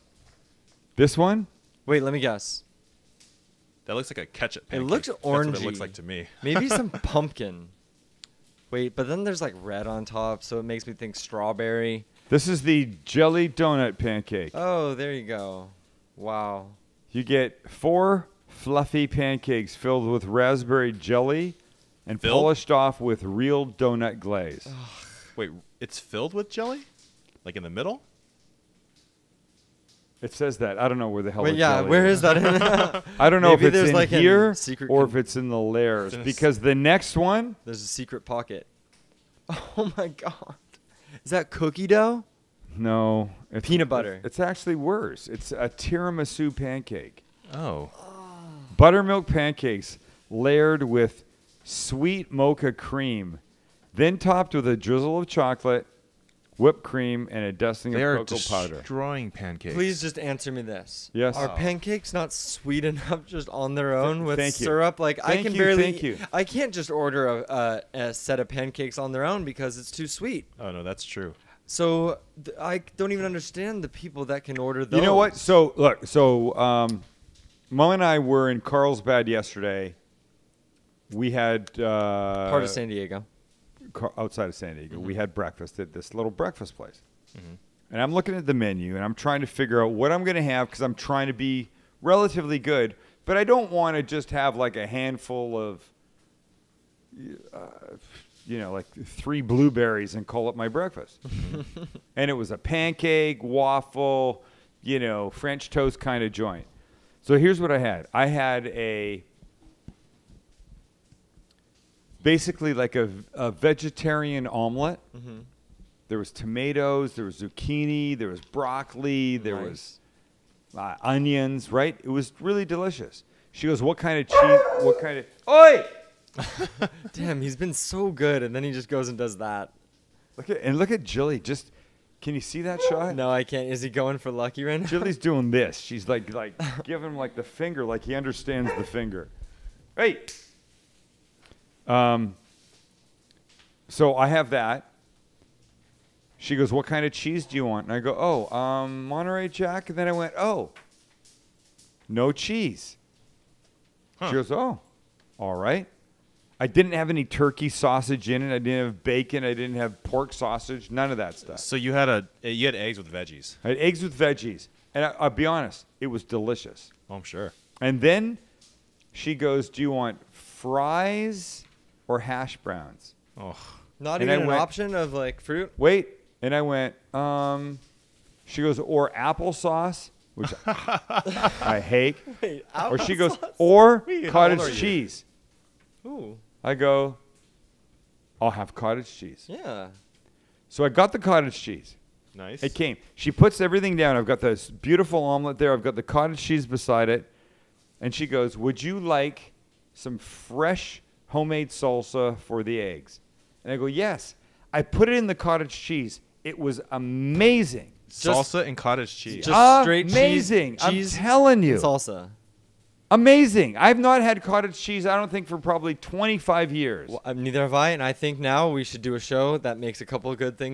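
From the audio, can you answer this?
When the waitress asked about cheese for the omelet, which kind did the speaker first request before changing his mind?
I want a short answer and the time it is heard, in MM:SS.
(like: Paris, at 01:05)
Monterey Jack, at 02:29.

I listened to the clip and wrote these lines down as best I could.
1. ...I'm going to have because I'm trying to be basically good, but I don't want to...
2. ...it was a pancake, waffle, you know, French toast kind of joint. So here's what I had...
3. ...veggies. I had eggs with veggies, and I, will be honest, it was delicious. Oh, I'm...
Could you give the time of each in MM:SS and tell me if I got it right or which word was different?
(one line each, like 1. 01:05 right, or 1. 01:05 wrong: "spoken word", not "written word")
1. 01:30 wrong: "relatively", not "basically"
2. 01:42 right
3. 02:43 right.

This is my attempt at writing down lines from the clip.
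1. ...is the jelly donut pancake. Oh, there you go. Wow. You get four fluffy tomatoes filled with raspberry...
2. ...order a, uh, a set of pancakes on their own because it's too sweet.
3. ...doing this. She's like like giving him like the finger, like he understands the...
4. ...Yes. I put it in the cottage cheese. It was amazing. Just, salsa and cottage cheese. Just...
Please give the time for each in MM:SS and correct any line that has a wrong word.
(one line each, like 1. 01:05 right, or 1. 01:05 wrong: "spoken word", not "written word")
1. 00:12 wrong: "pancakes", not "tomatoes"
2. 01:06 right
3. 02:15 right
4. 03:23 right.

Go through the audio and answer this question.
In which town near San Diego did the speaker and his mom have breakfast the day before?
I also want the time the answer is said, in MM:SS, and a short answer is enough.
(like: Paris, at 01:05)
Carlsbad, at 01:18.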